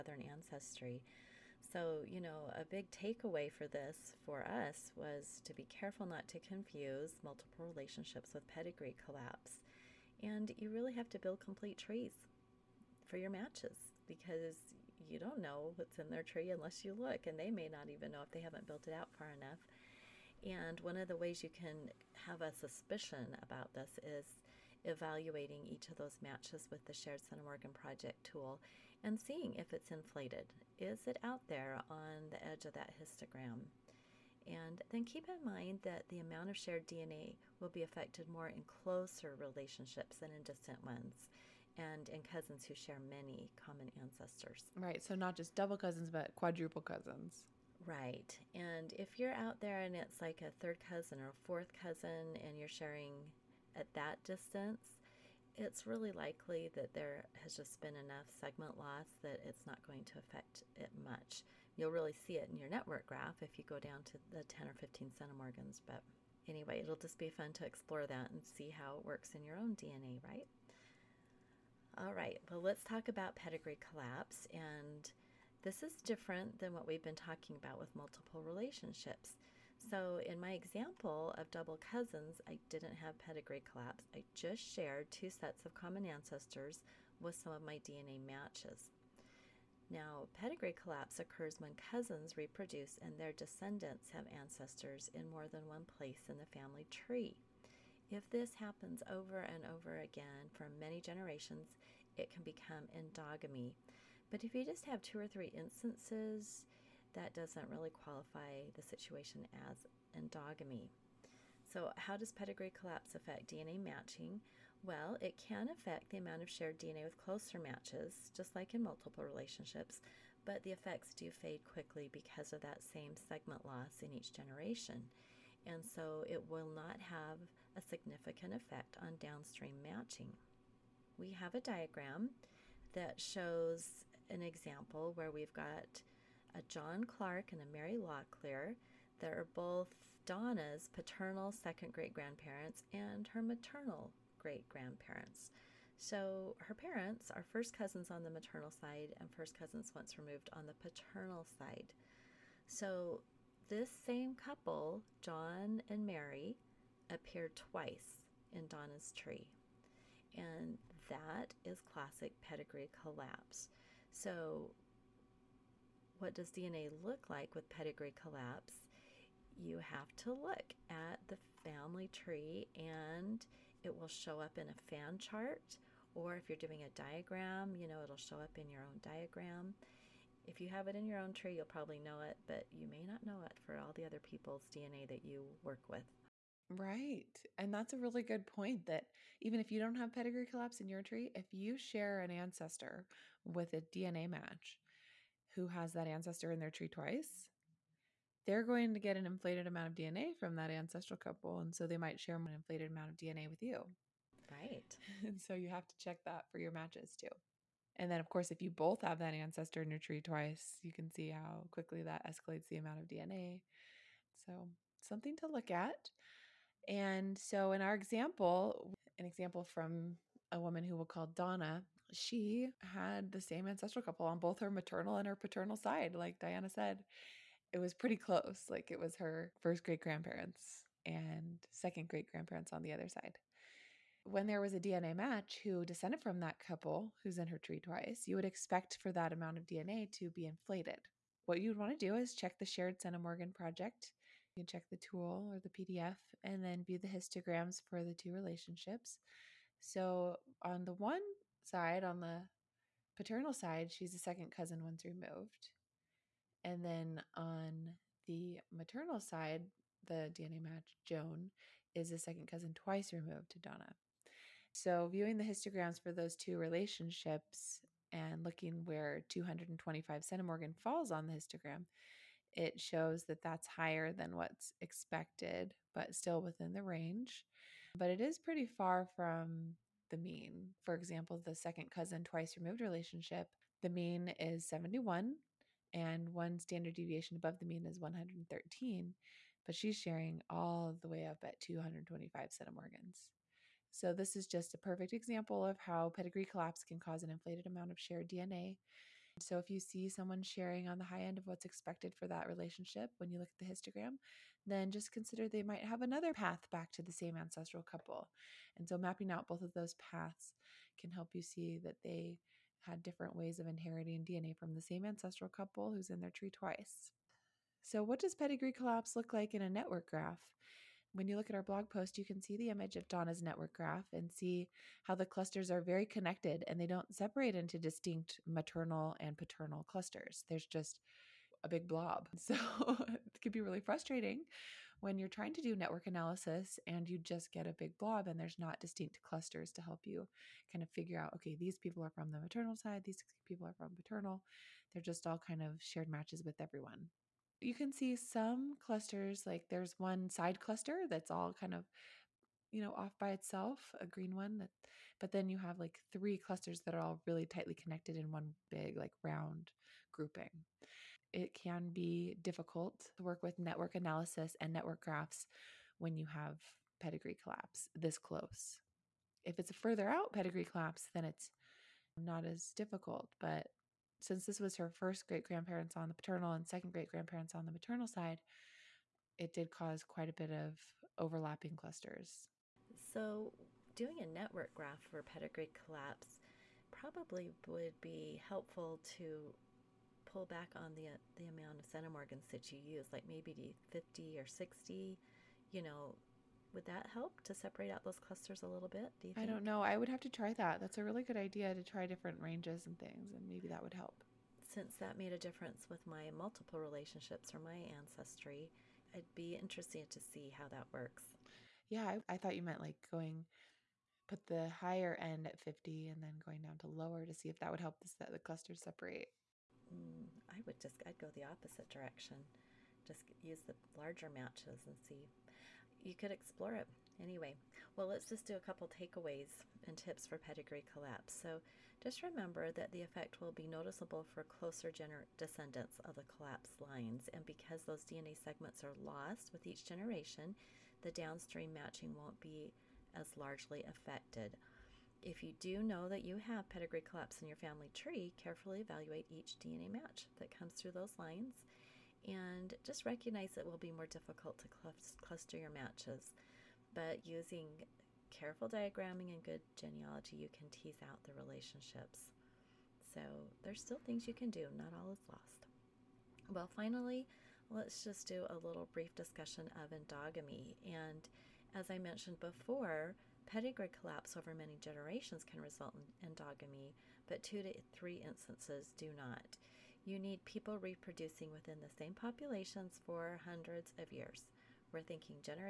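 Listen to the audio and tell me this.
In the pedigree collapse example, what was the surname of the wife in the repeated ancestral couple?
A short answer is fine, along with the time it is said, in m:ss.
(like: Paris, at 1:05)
Locklear, at 2:17.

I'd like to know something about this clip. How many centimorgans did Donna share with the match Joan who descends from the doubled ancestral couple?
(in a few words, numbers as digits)
225.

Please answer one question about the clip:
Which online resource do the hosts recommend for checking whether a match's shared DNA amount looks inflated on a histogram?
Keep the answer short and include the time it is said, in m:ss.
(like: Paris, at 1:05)
Shared Centimorgan Project, at 0:26.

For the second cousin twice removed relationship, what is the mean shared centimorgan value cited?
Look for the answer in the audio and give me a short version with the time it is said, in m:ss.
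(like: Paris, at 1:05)
71, at 4:44.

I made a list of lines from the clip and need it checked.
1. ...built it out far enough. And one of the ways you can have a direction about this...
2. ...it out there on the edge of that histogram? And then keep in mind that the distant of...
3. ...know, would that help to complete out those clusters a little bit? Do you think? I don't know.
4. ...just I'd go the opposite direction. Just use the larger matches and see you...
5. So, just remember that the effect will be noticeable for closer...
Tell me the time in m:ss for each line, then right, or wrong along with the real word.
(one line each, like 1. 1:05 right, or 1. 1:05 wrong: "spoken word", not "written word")
1. 0:18 wrong: "suspicion", not "direction"
2. 0:31 wrong: "amount", not "distant"
3. 6:35 wrong: "separate", not "complete"
4. 7:00 right
5. 7:11 right.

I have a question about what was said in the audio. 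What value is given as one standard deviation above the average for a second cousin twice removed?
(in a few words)
113.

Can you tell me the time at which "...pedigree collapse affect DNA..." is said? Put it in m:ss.
1:52.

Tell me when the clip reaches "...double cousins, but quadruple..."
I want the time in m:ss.
0:45.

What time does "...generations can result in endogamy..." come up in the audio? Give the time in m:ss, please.
7:54.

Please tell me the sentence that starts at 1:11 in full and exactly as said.
All right, well, let's talk about pedigree collapse and this is different than what we've been talking about with multiple relationships.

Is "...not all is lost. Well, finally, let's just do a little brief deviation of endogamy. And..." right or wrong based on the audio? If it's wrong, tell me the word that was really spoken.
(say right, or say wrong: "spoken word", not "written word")
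wrong: "discussion", not "deviation".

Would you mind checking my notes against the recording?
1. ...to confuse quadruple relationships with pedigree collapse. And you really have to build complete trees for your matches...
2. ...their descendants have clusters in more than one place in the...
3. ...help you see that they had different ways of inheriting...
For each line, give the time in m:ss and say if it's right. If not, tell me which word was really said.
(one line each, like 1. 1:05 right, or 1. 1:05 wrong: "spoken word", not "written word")
1. 0:06 wrong: "multiple", not "quadruple"
2. 1:33 wrong: "ancestors", not "clusters"
3. 5:11 right.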